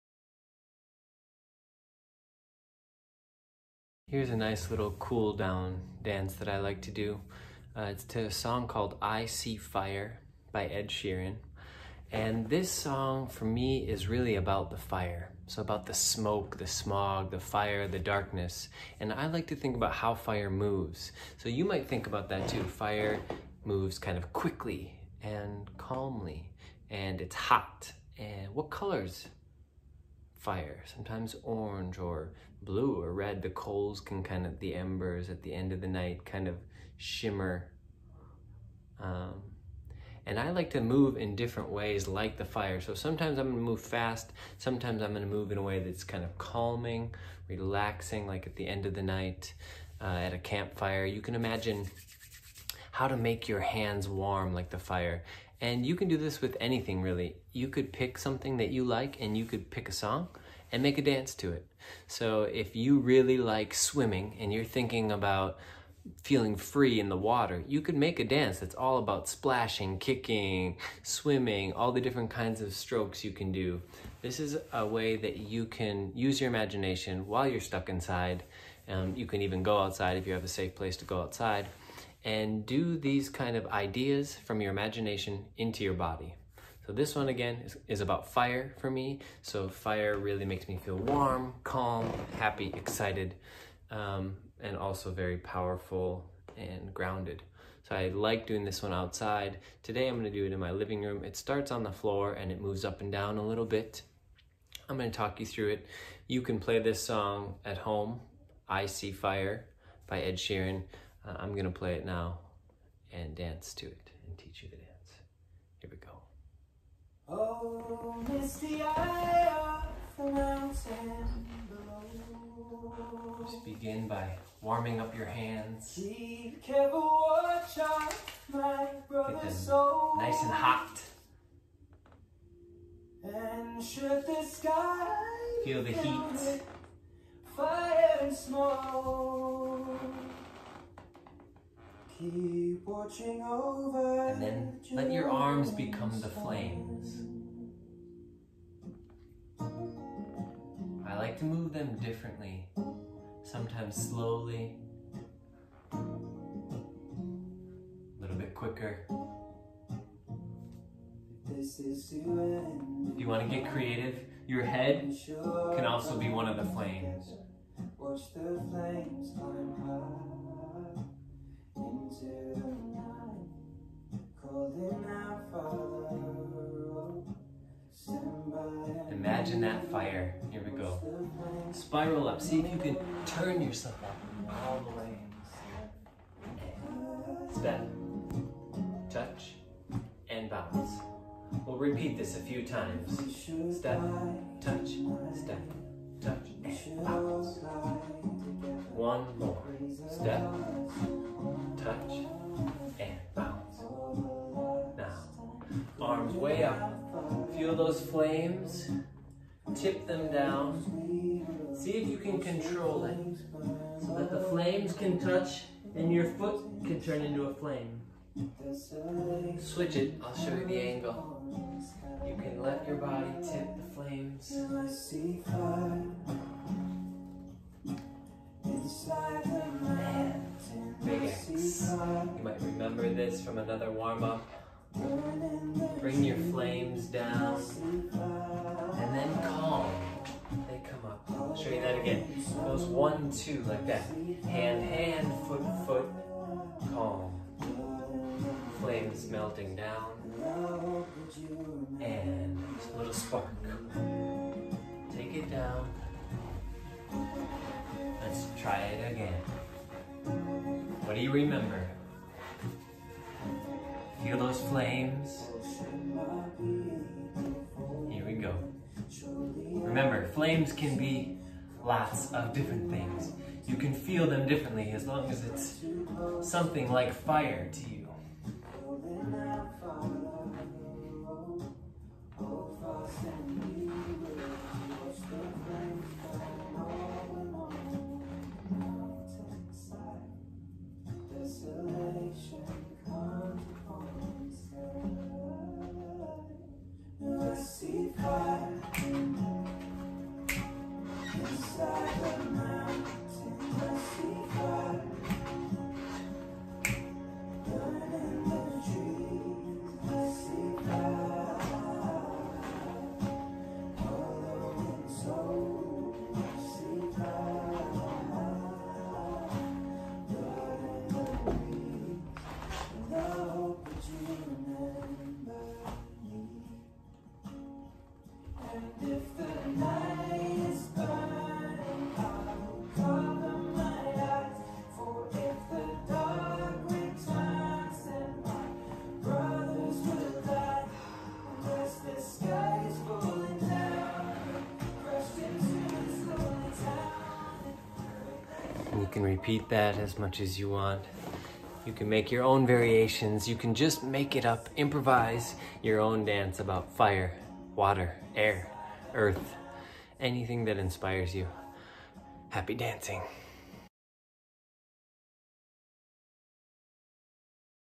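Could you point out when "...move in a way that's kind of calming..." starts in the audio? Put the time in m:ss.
0:45.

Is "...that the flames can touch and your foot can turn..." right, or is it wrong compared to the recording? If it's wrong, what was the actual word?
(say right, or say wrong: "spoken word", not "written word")
right.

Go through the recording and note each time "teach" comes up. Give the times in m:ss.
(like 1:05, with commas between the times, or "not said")
1:54.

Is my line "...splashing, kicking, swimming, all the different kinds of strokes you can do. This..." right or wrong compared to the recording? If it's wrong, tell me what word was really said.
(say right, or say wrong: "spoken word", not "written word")
right.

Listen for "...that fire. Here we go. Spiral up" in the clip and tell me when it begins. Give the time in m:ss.
2:59.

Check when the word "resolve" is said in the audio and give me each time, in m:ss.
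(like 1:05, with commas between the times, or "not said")
not said.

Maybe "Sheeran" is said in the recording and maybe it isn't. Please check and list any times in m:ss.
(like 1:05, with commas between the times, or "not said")
0:10, 1:50.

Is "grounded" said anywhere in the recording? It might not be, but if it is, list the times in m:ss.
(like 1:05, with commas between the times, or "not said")
1:36.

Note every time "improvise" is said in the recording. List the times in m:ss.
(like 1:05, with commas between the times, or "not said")
5:54.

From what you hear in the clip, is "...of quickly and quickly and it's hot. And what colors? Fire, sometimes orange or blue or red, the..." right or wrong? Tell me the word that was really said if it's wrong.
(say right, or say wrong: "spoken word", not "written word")
wrong: "calmly", not "quickly".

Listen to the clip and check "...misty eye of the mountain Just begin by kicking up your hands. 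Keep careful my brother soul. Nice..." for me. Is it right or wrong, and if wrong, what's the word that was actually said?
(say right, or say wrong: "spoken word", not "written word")
wrong: "warming", not "kicking".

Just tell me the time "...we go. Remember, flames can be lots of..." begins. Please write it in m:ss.
4:28.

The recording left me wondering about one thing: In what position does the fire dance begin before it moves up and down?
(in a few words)
On the floor.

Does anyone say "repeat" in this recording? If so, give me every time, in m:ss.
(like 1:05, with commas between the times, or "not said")
3:11, 5:49.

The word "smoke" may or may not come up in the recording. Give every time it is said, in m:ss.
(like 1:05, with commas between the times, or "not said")
0:15, 2:18.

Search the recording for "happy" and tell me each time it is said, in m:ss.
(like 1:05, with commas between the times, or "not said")
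1:32, 6:02.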